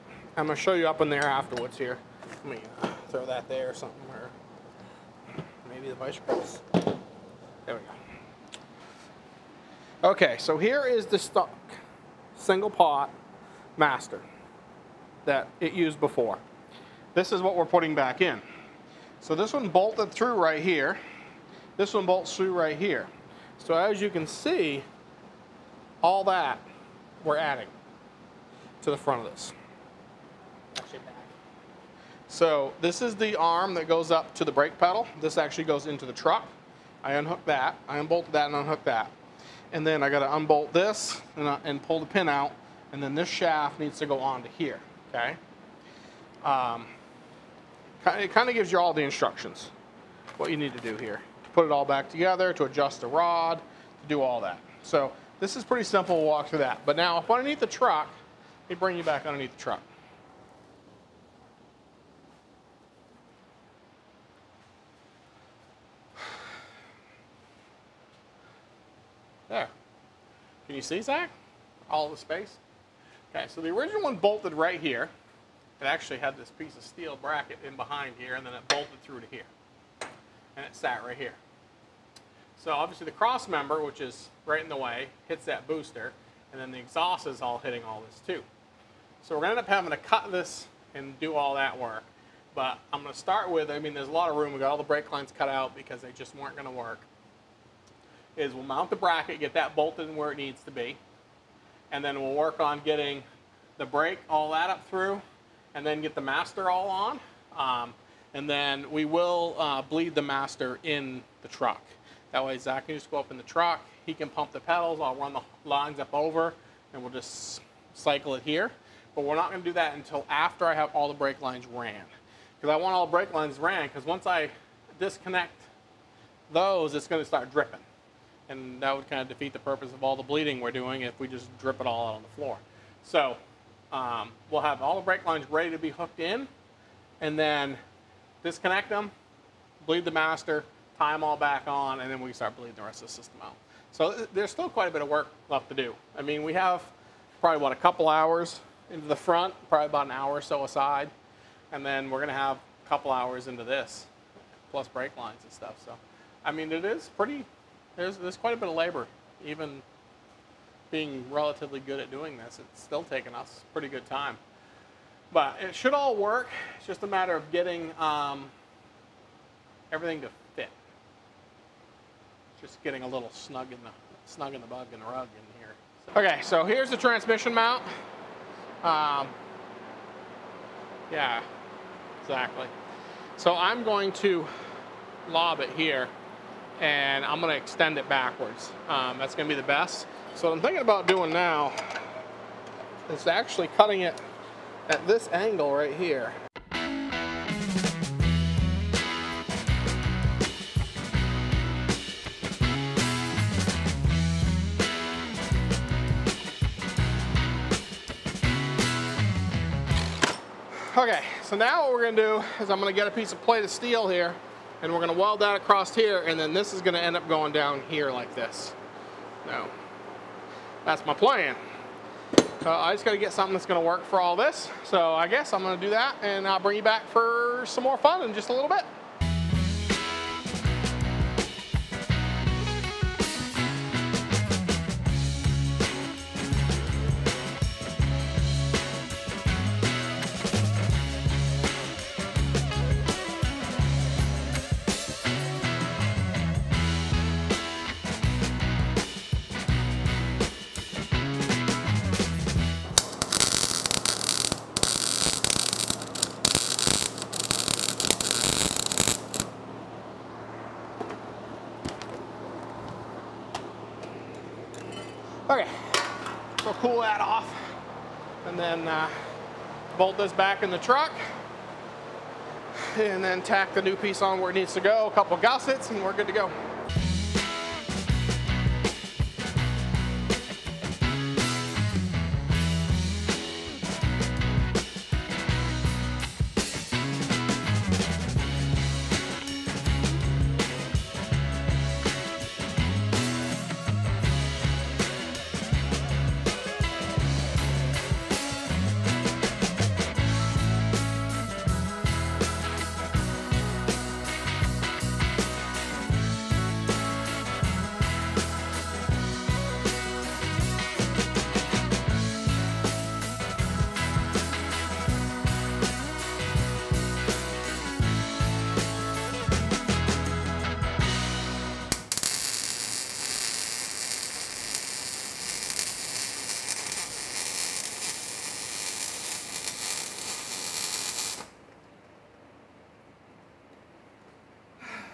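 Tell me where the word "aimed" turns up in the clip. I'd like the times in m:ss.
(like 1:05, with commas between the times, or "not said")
not said.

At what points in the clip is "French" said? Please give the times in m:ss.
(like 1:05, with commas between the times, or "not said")
not said.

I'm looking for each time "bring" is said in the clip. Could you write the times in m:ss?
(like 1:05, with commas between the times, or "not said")
0:58, 3:46.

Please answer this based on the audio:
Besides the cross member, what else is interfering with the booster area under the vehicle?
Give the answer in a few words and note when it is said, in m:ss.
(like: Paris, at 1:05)
The exhaust, at 1:26.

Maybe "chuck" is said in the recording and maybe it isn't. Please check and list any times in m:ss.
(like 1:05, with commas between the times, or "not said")
not said.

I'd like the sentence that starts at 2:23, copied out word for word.
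So uh, there's still quite a bit of work left to do.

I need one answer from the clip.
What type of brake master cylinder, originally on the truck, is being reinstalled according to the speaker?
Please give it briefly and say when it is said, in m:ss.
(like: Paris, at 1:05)
Stock single pot master, at 0:11.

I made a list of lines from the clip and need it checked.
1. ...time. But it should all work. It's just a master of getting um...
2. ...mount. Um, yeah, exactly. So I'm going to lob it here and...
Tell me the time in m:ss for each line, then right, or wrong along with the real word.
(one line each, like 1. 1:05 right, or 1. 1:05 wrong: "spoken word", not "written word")
1. 2:44 wrong: "matter", not "master"
2. 2:57 right.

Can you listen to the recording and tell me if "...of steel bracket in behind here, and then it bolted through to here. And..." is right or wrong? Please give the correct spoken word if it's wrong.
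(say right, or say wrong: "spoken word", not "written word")
right.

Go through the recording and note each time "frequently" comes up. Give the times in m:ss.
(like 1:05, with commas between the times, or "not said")
not said.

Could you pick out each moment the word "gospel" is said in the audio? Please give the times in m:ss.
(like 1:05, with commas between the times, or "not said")
not said.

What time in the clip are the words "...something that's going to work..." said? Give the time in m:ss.
3:43.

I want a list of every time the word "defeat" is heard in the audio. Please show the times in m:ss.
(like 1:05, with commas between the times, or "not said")
2:09.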